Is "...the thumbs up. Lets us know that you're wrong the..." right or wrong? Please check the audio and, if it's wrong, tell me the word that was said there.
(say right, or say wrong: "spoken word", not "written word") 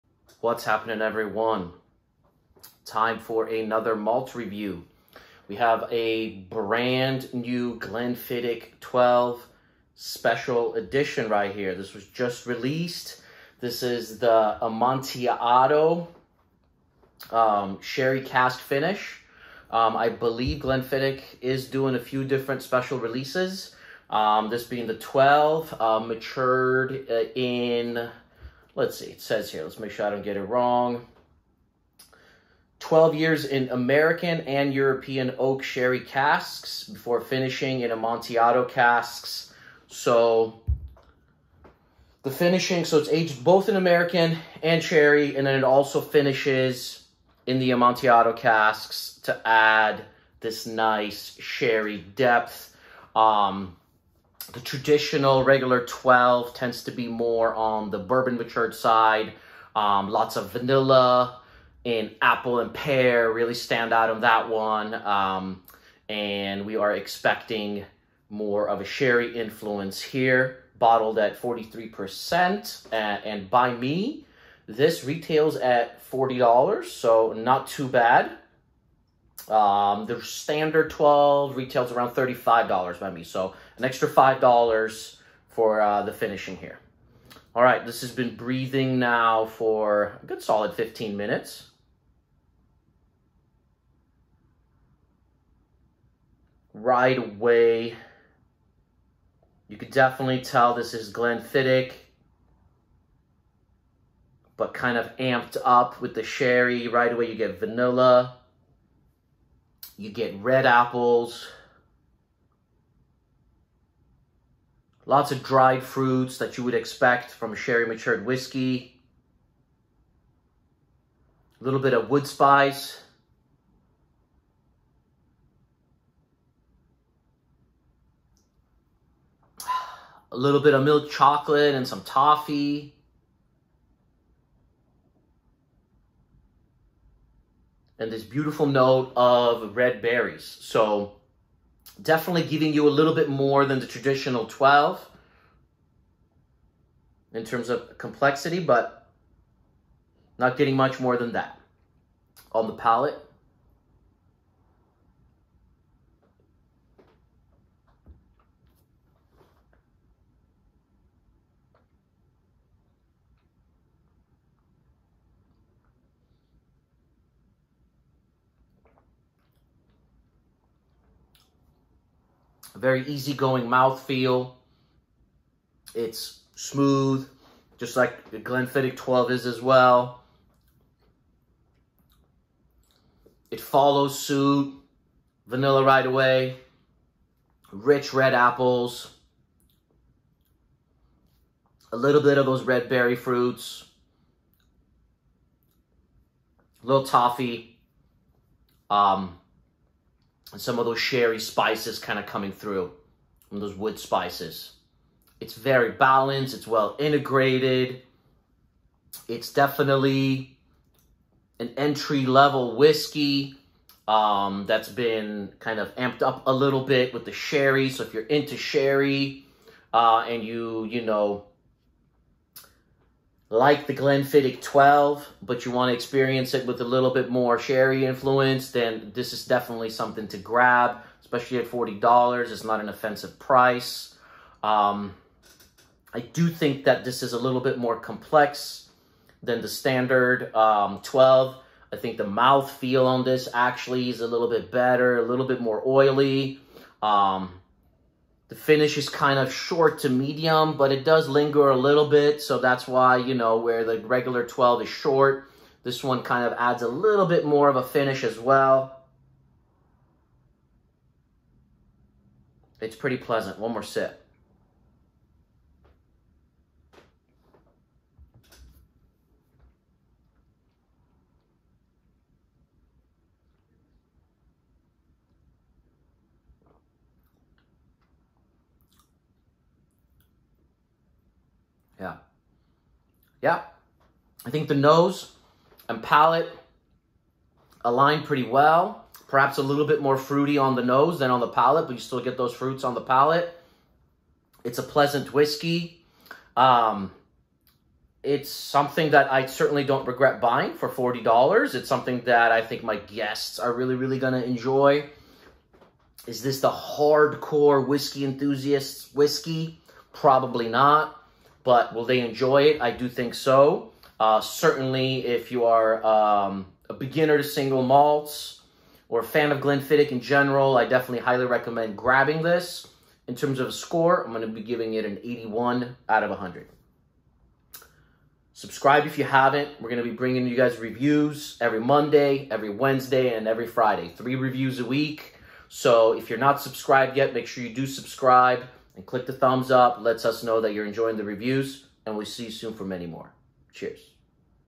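wrong: "enjoying", not "wrong".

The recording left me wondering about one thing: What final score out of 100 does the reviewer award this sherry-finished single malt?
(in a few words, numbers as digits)
81.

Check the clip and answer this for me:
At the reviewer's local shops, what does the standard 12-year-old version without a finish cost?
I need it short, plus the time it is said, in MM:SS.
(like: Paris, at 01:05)
$35, at 01:22.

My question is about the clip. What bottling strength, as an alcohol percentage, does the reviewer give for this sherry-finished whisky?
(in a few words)
43%.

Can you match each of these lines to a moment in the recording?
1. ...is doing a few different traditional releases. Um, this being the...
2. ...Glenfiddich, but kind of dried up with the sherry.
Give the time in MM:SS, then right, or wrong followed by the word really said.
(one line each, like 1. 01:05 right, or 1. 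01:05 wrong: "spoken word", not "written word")
1. 00:21 wrong: "special", not "traditional"
2. 01:41 wrong: "amped", not "dried".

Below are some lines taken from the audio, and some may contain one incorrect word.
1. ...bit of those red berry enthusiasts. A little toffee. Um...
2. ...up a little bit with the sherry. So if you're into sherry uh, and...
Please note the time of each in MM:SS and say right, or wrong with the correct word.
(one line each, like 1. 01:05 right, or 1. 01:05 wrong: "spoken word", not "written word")
1. 03:12 wrong: "fruits", not "enthusiasts"
2. 03:36 right.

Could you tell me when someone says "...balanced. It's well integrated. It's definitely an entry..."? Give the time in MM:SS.
03:25.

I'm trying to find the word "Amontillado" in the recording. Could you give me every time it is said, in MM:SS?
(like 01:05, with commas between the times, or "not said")
00:14, 00:37, 00:47.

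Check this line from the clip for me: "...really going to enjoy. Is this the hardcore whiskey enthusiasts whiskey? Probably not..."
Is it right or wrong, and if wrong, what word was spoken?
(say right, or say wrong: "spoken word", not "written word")
right.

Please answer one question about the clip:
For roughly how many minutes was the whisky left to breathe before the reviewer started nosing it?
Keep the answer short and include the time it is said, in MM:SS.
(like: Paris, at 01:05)
15, at 01:30.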